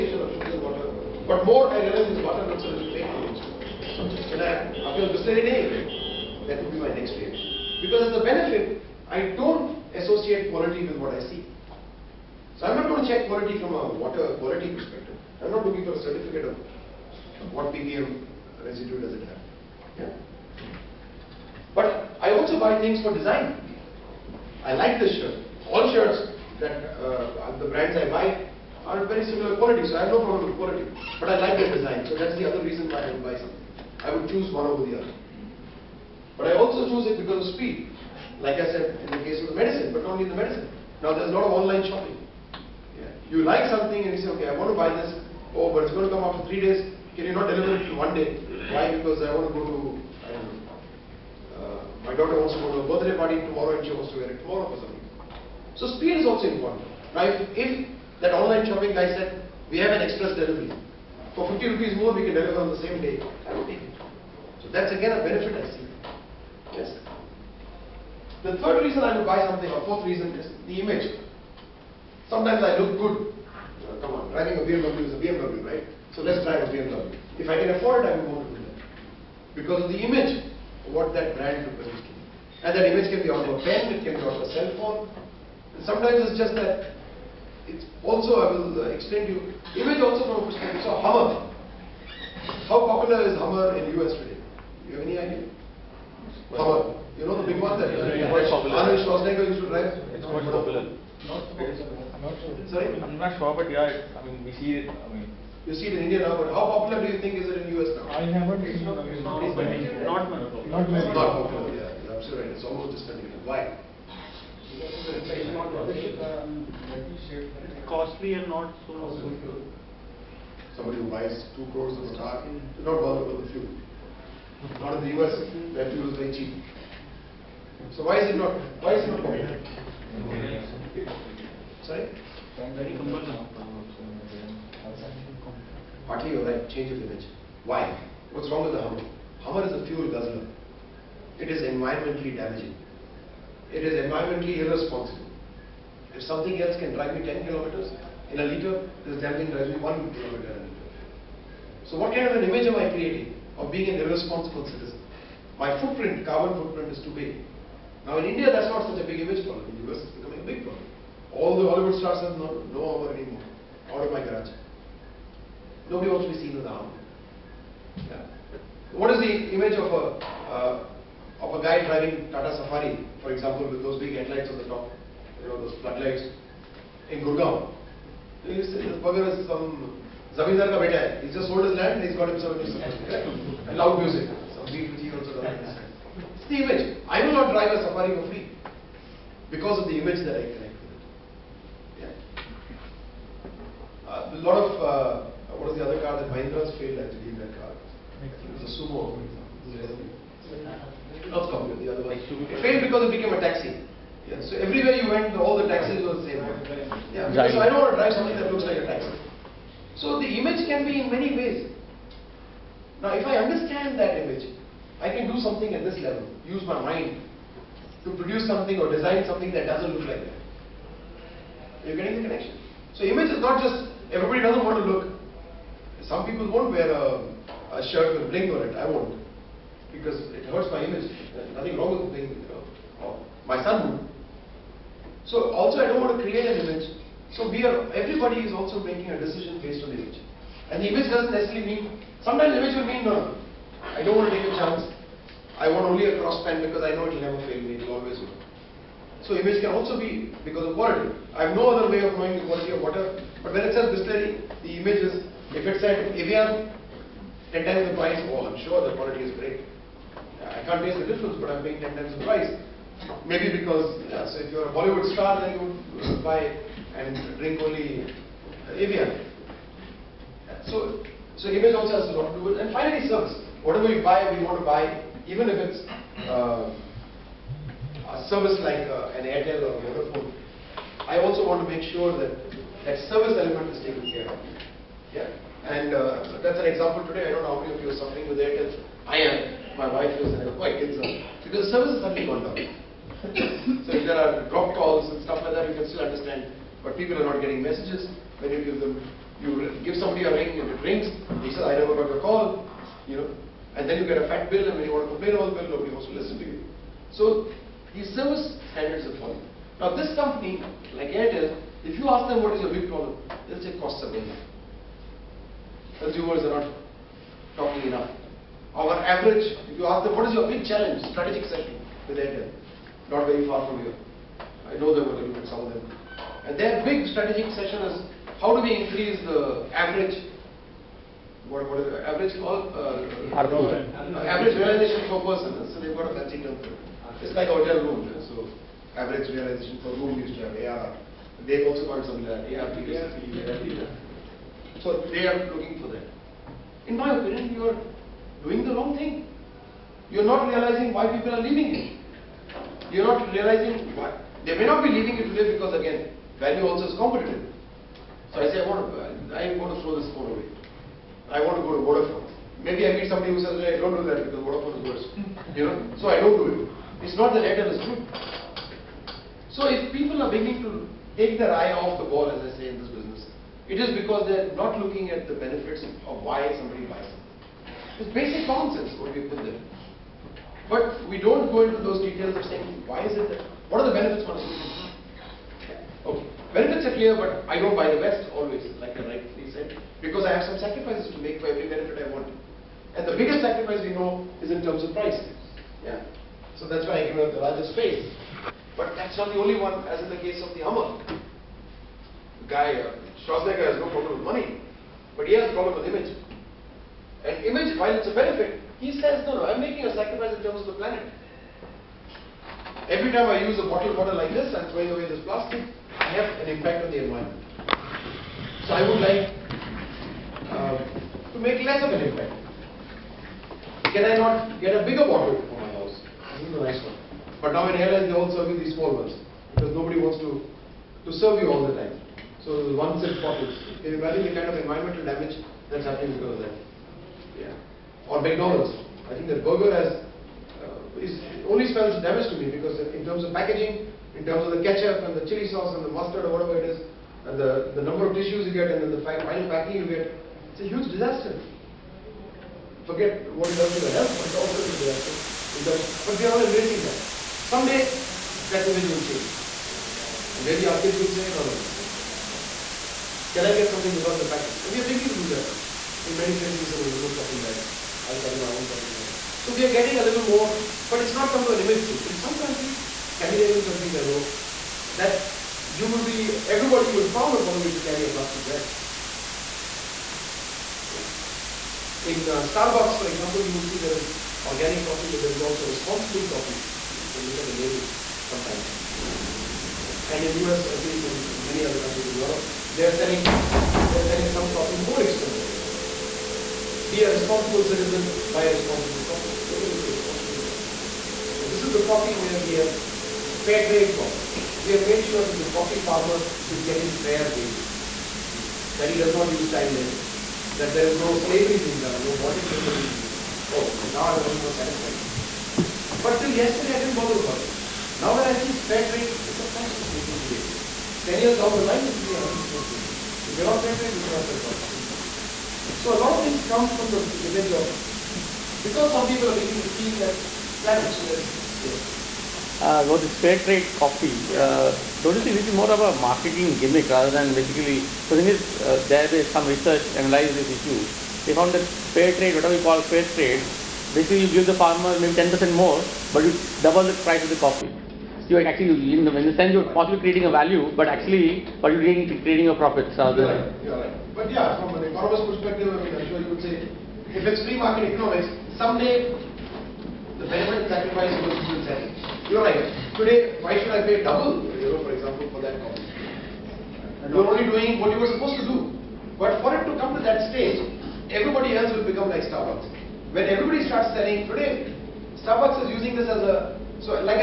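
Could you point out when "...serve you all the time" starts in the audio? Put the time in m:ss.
7:11.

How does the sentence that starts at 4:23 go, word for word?
Maybe because, yeah, so if you're a Bollywood star, then you buy and drink only Evian.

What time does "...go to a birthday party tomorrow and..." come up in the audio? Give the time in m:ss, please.
0:52.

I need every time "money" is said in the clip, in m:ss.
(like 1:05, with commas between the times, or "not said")
6:44.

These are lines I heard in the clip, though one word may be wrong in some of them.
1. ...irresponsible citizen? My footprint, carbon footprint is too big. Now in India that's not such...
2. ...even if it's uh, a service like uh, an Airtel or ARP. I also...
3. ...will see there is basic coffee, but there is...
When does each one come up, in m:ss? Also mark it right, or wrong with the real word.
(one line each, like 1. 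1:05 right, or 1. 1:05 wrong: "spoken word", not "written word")
1. 2:33 right
2. 4:35 wrong: "Vodafone", not "ARP"
3. 8:03 wrong: "organic", not "basic".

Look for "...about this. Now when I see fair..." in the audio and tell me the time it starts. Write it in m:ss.
8:37.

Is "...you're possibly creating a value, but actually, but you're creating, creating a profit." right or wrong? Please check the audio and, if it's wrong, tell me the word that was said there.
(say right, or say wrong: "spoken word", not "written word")
right.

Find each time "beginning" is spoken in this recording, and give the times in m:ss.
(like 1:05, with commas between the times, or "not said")
6:10, 7:44, 8:49.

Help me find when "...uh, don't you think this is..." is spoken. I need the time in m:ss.
8:54.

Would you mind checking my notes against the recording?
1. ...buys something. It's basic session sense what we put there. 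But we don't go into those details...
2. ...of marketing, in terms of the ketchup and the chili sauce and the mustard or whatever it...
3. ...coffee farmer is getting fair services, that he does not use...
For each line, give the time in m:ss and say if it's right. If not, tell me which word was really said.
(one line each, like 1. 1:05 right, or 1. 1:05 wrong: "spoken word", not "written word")
1. 6:16 wrong: "common", not "session"
2. 7:23 wrong: "packaging", not "marketing"
3. 8:25 wrong: "wages", not "services".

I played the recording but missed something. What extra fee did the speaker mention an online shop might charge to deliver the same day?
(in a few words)
50 rupees.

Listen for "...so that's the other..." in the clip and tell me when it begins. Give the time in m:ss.
0:32.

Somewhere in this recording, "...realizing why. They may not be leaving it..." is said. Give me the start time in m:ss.
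5:53.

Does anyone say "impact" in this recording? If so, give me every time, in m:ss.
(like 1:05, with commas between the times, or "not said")
6:56, 7:01.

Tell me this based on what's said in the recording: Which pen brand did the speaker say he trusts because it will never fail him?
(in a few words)
Cross.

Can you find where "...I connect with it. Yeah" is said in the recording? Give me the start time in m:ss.
3:10.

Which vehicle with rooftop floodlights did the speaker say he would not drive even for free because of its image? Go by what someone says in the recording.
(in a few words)
Tata Safari.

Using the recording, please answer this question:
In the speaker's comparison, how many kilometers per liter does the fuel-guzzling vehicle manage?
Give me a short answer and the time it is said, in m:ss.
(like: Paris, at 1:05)
1, at 2:29.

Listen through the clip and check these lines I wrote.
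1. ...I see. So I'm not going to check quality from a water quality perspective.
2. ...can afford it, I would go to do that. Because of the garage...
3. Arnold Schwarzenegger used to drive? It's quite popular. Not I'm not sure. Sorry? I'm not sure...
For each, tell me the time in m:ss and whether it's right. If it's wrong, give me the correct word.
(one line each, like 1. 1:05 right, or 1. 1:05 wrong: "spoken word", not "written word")
1. 0:11 right
2. 1:17 wrong: "image", not "garage"
3. 1:38 right.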